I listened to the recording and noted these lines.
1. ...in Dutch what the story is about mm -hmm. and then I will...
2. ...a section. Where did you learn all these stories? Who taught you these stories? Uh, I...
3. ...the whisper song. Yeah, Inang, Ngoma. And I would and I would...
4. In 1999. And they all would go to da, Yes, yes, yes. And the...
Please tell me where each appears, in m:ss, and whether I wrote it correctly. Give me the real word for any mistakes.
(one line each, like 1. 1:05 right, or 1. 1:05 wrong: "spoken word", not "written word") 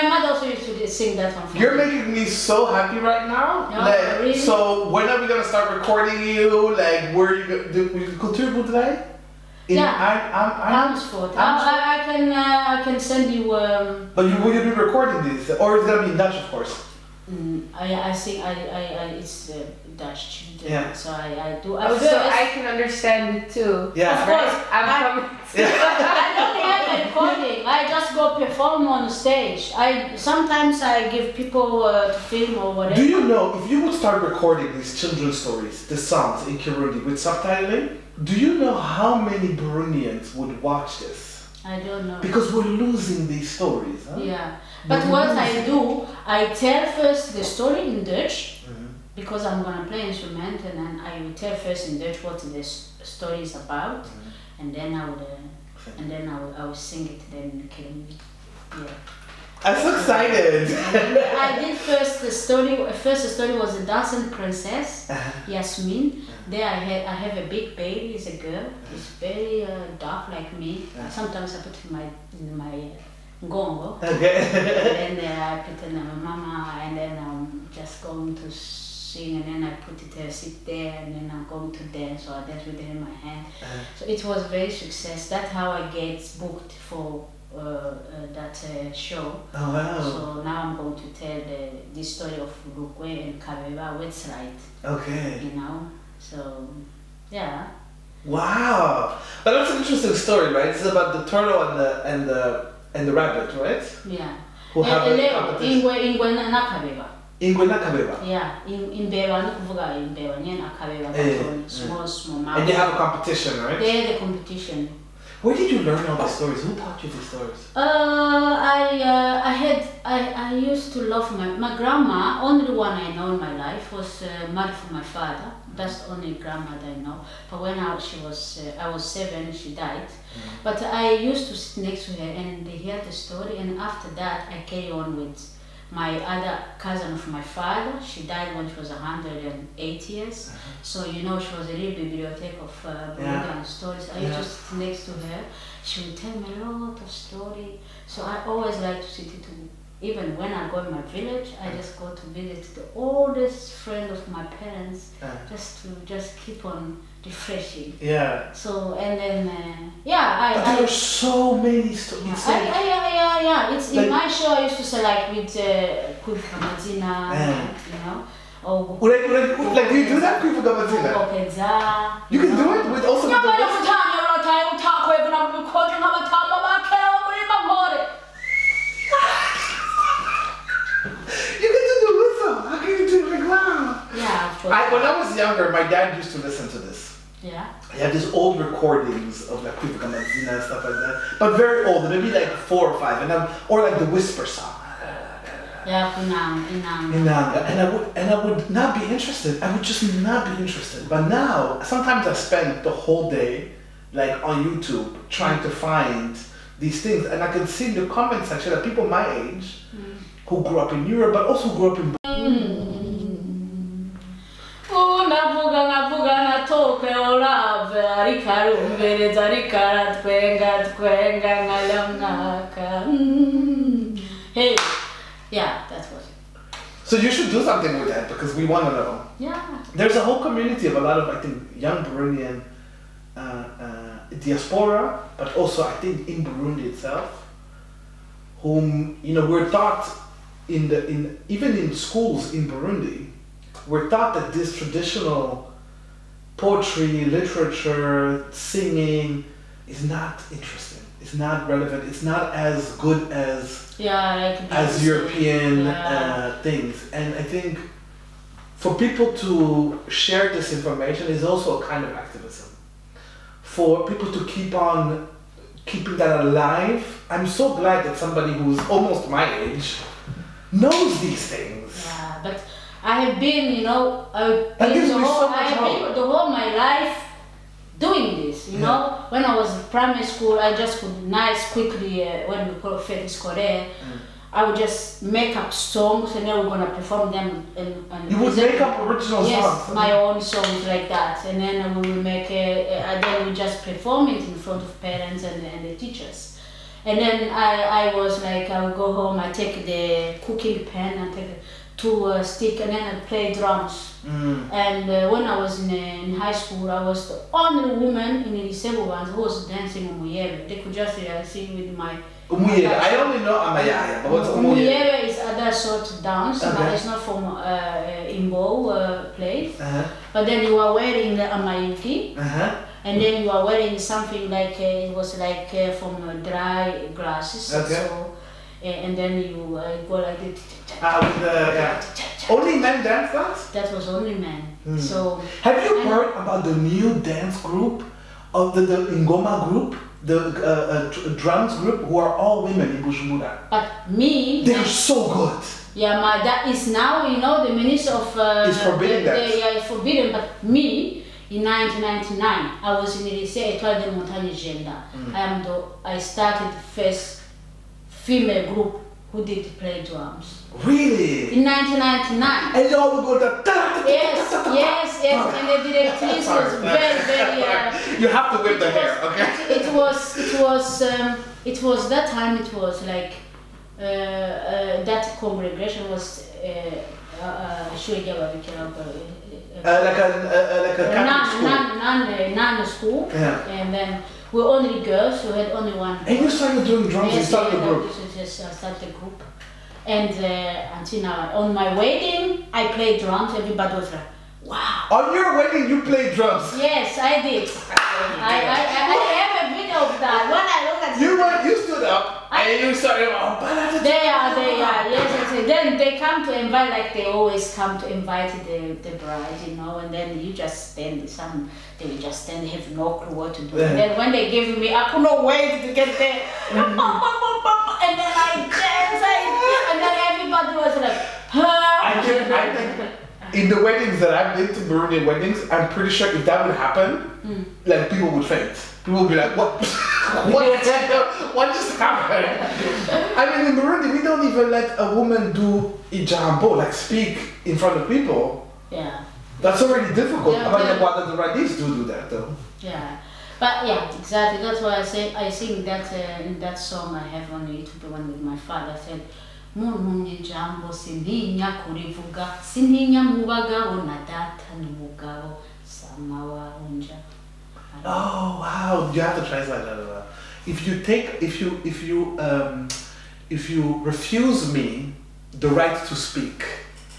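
1. 0:51 right
2. 1:54 wrong: "competition", not "section"
3. 3:13 wrong: "Inang", not "Ngoma"
4. 6:01 right.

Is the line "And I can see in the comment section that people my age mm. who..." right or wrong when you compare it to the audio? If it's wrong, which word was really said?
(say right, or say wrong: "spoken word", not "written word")
right.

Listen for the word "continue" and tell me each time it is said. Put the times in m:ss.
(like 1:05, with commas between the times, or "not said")
0:08.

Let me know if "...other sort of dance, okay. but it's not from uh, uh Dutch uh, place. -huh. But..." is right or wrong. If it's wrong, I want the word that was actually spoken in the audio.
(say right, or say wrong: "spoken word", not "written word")
wrong: "Imbo", not "Dutch".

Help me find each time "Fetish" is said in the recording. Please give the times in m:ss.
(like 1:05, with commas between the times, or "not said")
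4:43.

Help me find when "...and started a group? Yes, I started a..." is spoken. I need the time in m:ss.
6:27.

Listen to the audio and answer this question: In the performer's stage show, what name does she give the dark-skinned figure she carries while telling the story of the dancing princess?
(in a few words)
Yasmin.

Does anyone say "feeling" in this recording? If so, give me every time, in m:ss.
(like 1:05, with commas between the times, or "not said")
not said.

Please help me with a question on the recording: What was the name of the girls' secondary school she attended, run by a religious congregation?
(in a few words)
Lycée Étoile de Montagne.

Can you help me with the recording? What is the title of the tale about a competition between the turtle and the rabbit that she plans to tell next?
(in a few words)
Lukwe and Kabeba.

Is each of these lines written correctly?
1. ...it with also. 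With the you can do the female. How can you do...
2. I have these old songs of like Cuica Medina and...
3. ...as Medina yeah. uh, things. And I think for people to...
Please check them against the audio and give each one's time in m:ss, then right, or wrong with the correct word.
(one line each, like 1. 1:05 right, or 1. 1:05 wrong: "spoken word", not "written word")
1. 2:52 wrong: "whistle", not "female"
2. 3:07 wrong: "recordings", not "songs"
3. 4:14 wrong: "European", not "Medina".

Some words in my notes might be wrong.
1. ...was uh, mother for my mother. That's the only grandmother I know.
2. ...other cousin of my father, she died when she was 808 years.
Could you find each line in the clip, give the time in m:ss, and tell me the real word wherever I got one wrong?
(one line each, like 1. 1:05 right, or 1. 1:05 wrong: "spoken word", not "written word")
1. 2:03 wrong: "father", not "mother"
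2. 2:16 wrong: "108", not "808".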